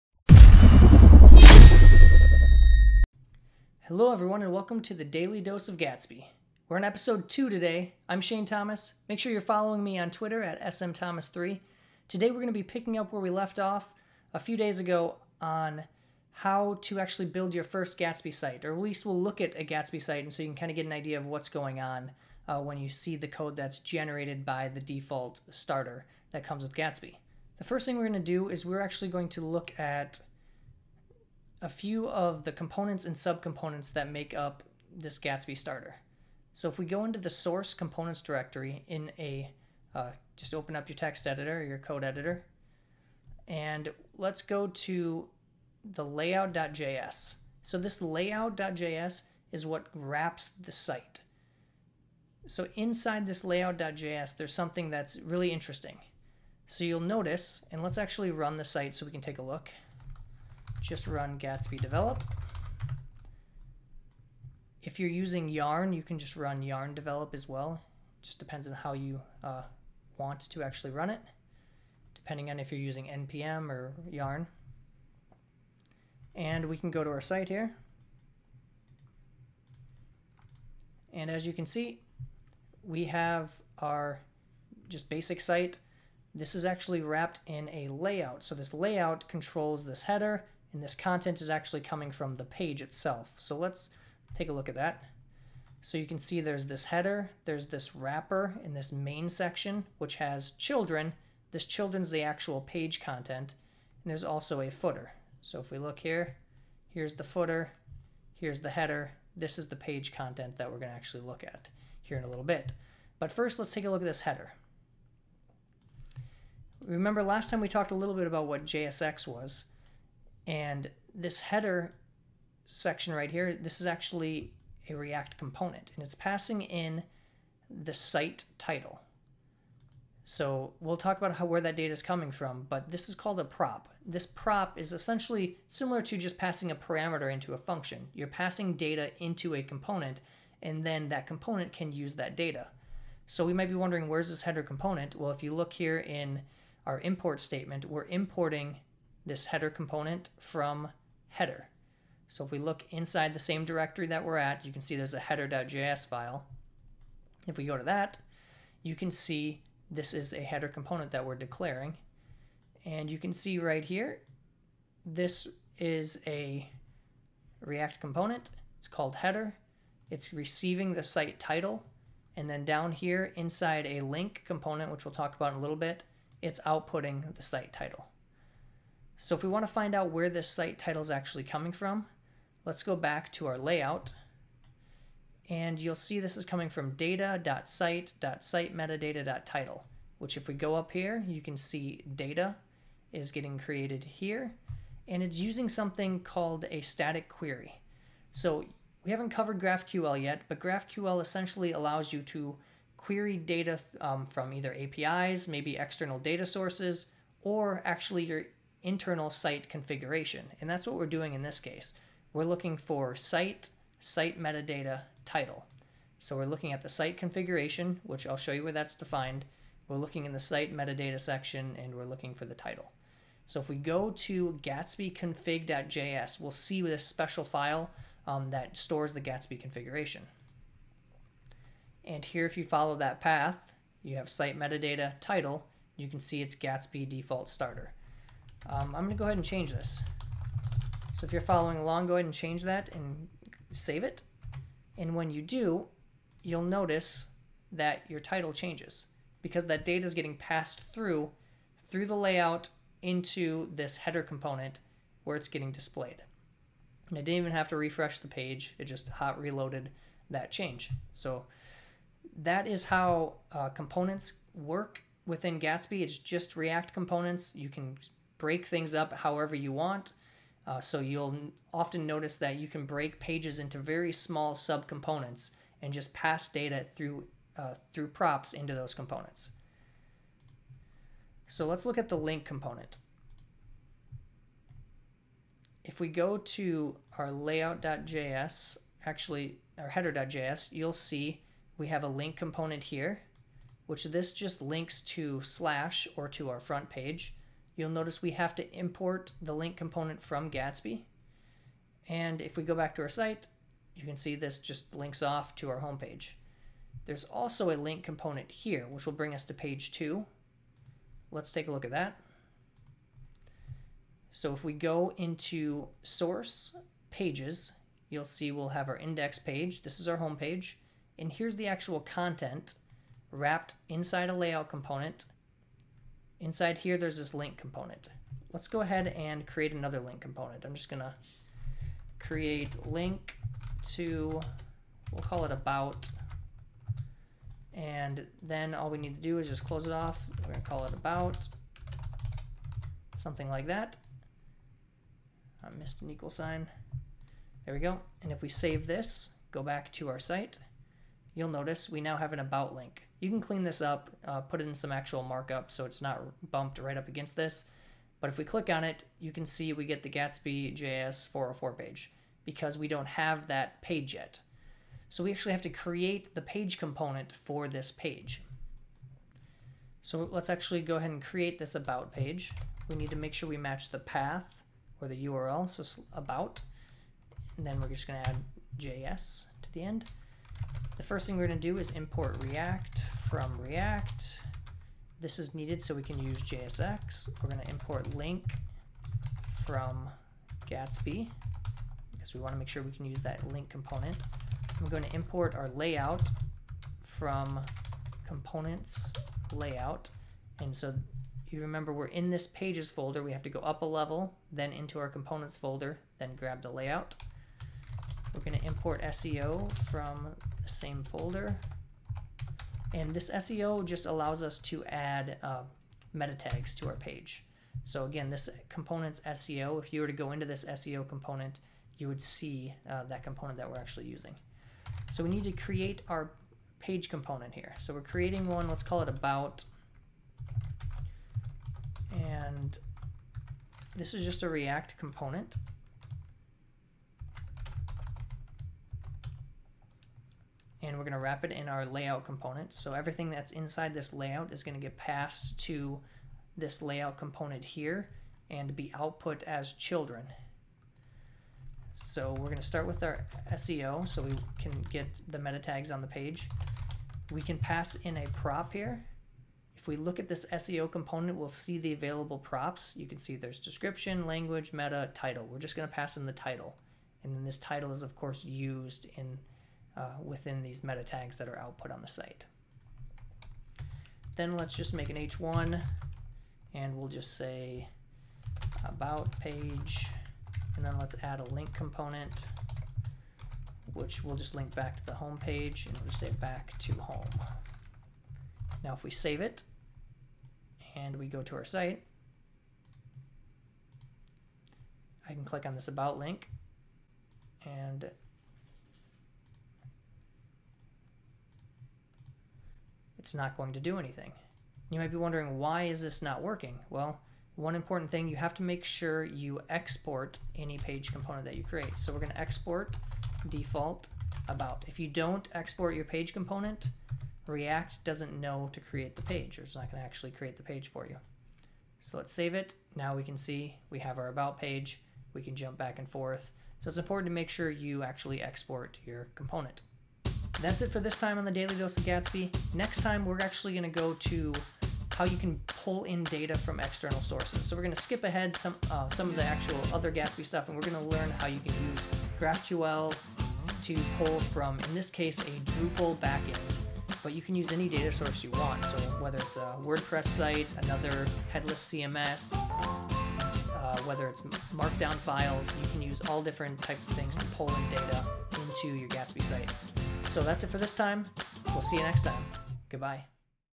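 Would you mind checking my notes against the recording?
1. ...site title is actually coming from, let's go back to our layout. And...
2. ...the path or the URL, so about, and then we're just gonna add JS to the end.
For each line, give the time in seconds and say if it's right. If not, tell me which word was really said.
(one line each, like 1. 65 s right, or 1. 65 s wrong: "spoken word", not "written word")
1. 180 s right
2. 373 s right.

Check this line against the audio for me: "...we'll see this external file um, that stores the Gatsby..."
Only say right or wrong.
wrong.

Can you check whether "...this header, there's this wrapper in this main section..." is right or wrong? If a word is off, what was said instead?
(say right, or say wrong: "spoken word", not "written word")
right.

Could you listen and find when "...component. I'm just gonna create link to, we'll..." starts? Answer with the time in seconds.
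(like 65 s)
330 s.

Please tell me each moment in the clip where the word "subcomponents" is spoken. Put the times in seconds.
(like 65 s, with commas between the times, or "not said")
33 s, 274 s.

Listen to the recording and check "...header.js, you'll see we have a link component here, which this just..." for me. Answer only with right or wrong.
right.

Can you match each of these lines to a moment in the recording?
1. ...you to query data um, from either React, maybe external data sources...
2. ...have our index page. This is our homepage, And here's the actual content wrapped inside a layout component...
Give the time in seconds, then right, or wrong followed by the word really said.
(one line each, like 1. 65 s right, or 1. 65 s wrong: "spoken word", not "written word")
1. 202 s wrong: "APIs", not "React"
2. 318 s right.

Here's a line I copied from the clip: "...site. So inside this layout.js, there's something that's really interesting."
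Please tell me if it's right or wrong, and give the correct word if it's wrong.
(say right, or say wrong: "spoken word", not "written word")
right.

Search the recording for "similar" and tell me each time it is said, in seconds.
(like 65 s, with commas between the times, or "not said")
135 s.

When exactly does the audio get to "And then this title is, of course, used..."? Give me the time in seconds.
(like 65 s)
467 s.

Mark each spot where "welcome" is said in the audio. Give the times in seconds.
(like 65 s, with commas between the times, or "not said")
4 s.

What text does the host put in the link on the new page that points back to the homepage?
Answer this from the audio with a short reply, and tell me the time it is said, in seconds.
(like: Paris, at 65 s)
back to home, at 486 s.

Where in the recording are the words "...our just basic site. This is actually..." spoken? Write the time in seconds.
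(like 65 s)
83 s.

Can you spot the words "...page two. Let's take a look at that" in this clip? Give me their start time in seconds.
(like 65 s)
309 s.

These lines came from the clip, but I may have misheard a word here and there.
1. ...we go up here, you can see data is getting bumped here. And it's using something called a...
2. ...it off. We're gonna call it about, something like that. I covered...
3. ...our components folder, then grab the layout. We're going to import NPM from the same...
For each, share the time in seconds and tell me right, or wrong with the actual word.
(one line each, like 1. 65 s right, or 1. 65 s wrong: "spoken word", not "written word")
1. 190 s wrong: "created", not "bumped"
2. 339 s wrong: "missed", not "covered"
3. 404 s wrong: "SEO", not "NPM".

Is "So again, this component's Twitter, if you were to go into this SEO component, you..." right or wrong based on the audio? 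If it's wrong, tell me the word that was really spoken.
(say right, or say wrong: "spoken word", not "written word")
wrong: "SEO", not "Twitter".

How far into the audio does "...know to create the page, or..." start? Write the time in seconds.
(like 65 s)
518 s.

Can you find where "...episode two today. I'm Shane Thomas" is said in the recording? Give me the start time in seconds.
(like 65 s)
6 s.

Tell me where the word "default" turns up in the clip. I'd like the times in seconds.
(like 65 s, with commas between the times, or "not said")
24 s, 237 s, 513 s.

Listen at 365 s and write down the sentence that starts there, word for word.
So we actually have to create the page component for this page.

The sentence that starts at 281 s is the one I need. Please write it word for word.
So let's look at the link component.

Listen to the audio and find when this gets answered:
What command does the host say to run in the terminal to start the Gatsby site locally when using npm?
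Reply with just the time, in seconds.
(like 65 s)
61 s.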